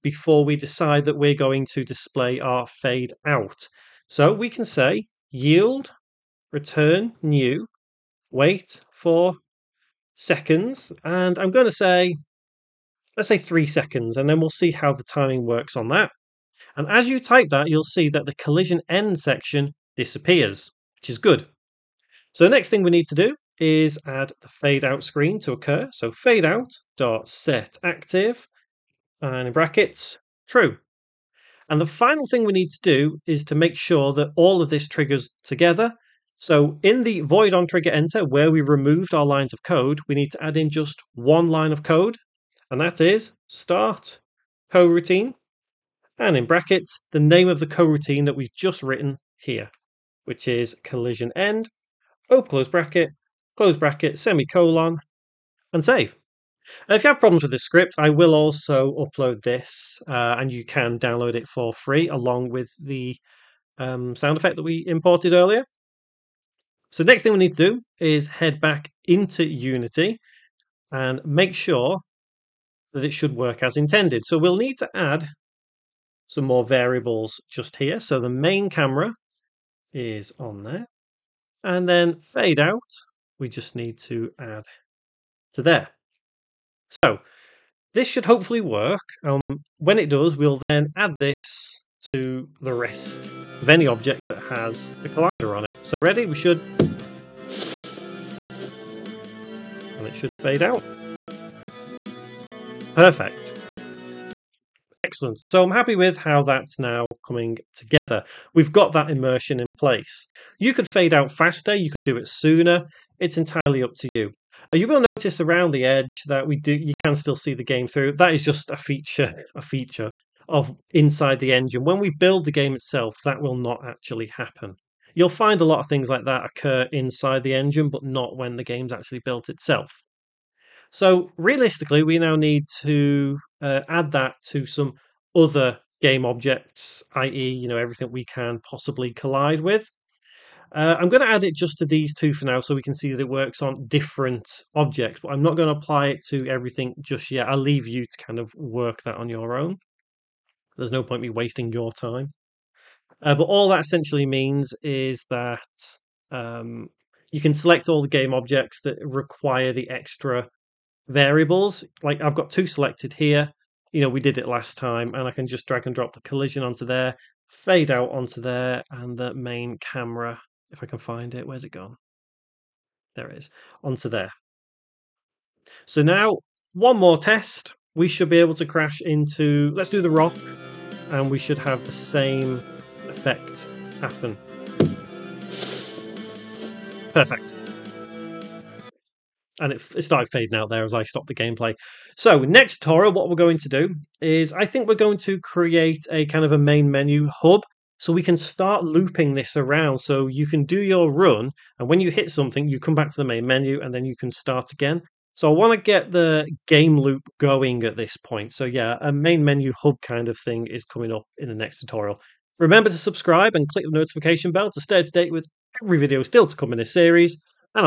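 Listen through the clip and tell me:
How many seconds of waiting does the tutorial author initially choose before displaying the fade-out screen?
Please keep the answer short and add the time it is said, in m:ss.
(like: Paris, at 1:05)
3, at 0:13.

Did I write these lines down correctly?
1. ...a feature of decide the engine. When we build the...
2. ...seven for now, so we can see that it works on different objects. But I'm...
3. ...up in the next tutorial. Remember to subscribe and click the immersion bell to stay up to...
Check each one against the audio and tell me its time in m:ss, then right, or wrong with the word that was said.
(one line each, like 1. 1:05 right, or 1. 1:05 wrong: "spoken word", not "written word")
1. 1:59 wrong: "inside", not "decide"
2. 2:22 wrong: "two", not "seven"
3. 3:31 wrong: "notification", not "immersion".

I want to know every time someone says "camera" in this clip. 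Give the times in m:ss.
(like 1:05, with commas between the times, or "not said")
1:18, 2:49.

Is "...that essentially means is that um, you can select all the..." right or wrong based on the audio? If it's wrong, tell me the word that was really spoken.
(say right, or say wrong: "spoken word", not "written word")
right.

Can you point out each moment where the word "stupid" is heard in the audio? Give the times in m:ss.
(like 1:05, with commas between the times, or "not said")
not said.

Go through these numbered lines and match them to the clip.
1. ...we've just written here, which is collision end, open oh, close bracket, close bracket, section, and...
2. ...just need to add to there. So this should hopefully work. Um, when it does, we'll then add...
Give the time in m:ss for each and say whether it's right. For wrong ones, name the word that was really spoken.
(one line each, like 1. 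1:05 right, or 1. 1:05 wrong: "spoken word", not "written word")
1. 0:48 wrong: "semicolon", not "section"
2. 1:23 right.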